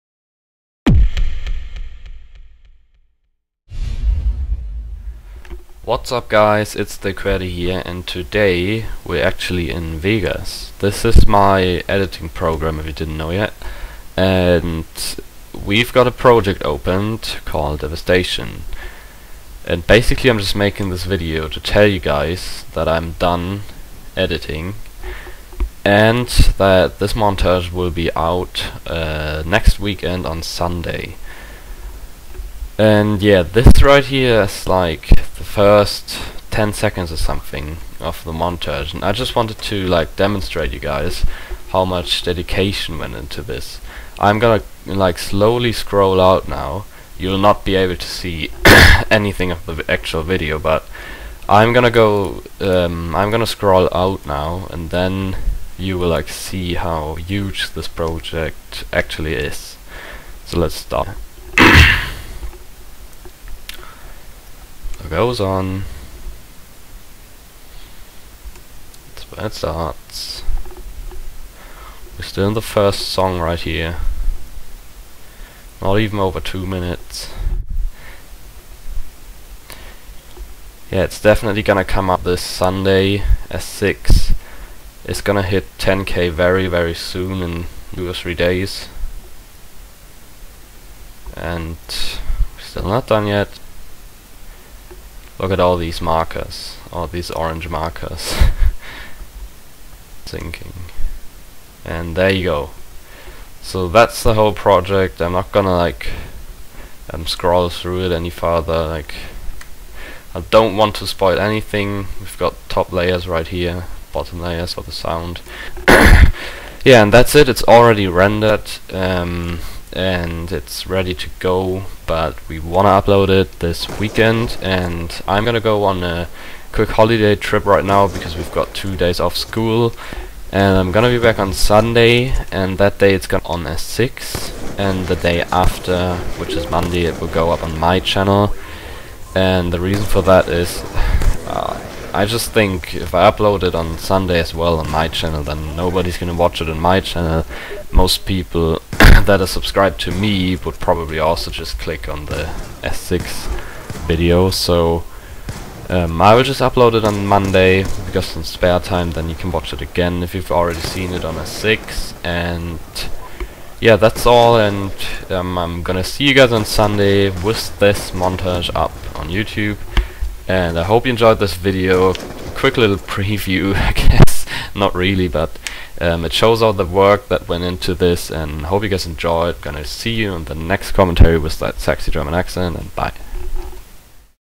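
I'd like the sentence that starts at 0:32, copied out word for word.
And yeah, this right here is like the first 10 seconds or something of the montage.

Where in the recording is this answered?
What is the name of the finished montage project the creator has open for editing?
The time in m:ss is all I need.
0:17.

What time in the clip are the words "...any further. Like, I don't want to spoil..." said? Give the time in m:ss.
1:48.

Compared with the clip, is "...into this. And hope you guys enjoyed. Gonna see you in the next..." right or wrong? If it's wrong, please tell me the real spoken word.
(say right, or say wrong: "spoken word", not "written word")
right.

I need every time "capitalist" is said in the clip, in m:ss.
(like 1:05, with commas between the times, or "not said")
not said.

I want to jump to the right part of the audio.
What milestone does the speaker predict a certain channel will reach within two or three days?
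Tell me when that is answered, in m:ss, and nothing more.
1:25.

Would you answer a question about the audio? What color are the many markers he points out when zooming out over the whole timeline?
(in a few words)
Orange.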